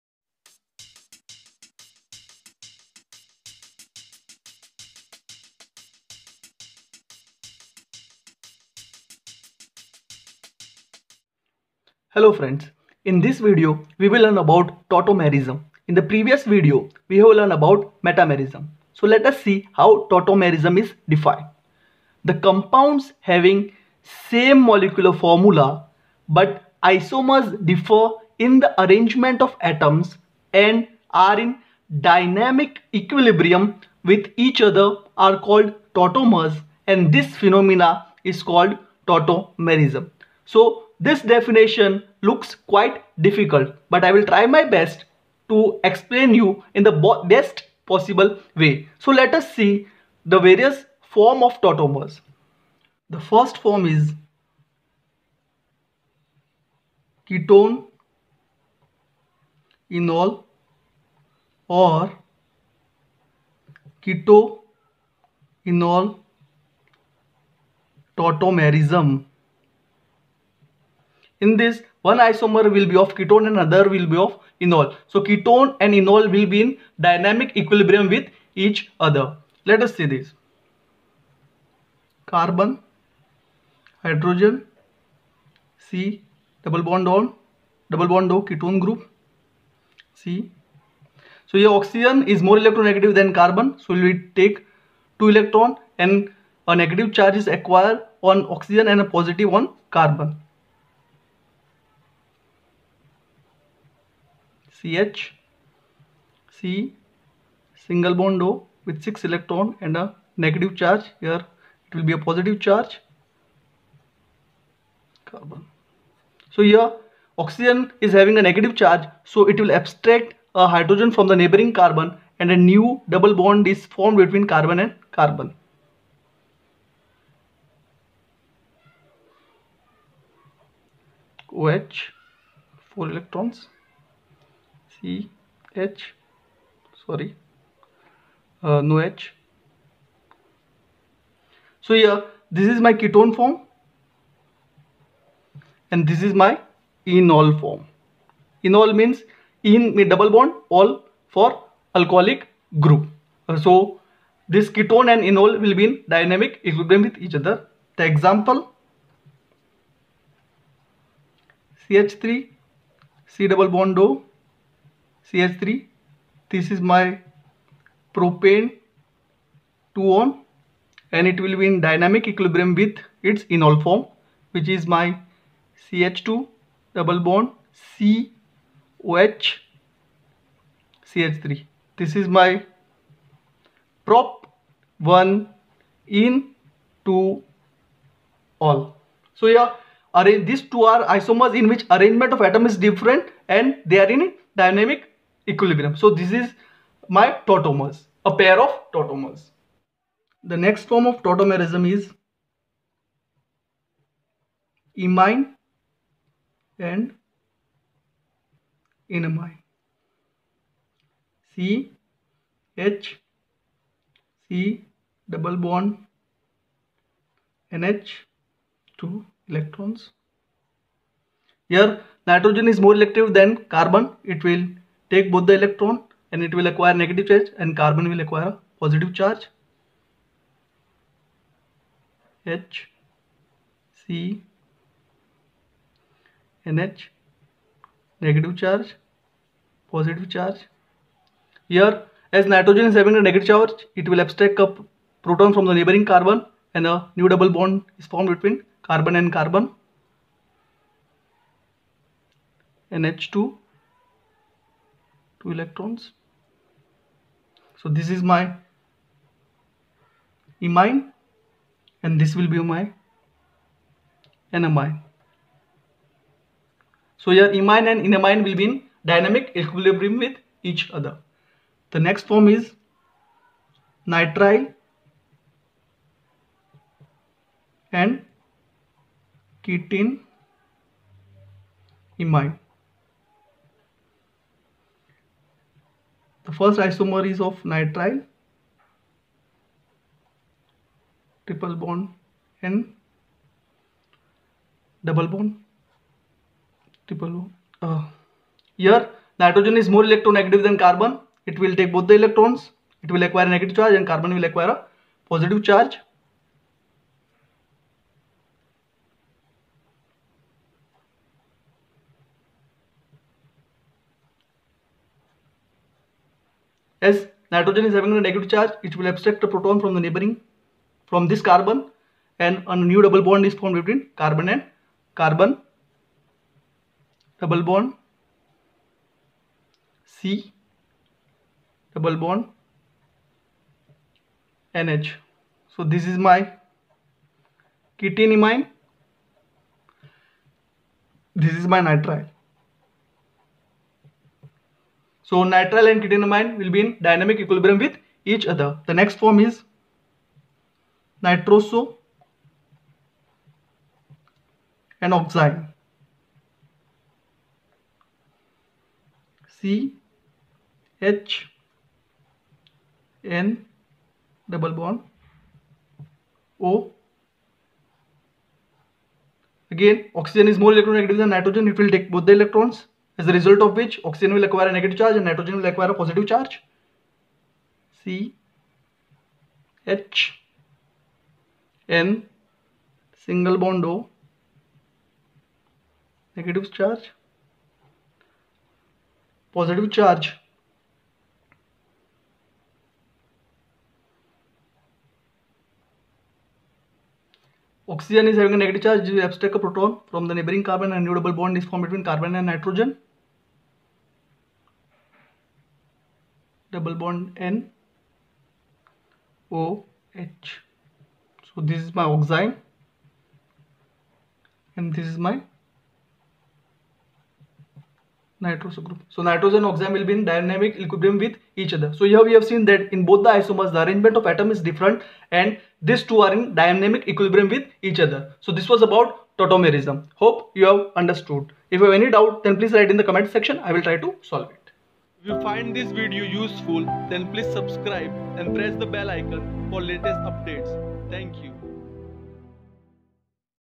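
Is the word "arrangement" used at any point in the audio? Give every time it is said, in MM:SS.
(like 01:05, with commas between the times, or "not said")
00:28, 03:11, 07:03.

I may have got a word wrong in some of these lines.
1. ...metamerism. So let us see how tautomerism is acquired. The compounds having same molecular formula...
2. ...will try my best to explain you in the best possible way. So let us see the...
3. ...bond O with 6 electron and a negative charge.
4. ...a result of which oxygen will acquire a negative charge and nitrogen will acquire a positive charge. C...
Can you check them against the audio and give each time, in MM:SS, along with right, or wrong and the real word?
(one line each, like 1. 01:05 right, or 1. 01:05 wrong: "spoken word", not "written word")
1. 00:18 wrong: "defined", not "acquired"
2. 00:44 right
3. 01:48 right
4. 06:13 right.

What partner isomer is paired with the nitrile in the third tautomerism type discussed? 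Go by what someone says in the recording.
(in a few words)
Ketene imine.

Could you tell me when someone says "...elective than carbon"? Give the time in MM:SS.
03:42.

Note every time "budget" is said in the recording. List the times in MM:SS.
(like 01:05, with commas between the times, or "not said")
not said.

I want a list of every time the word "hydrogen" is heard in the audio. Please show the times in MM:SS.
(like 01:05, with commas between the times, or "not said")
01:24, 02:00.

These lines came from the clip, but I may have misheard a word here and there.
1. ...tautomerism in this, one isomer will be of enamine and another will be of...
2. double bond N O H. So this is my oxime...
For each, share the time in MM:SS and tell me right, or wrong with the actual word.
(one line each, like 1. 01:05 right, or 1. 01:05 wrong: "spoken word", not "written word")
1. 01:08 wrong: "ketone", not "enamine"
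2. 06:46 right.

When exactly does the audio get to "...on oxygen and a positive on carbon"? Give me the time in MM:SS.
01:38.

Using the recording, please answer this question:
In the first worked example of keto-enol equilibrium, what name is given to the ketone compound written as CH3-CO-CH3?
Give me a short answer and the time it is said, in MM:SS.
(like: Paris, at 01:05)
propan-2-one, at 02:48.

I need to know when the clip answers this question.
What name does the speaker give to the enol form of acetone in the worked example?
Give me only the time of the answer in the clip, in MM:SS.
03:04.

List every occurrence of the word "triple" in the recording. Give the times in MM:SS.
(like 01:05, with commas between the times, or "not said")
04:51, 04:57.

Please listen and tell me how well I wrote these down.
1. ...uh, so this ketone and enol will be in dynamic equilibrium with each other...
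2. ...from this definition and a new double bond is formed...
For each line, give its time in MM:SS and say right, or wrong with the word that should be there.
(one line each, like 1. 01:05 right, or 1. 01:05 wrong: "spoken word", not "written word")
1. 02:33 right
2. 05:21 wrong: "carbon", not "definition".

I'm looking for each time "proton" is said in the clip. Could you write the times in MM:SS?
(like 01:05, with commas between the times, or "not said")
04:05, 05:19, 06:39.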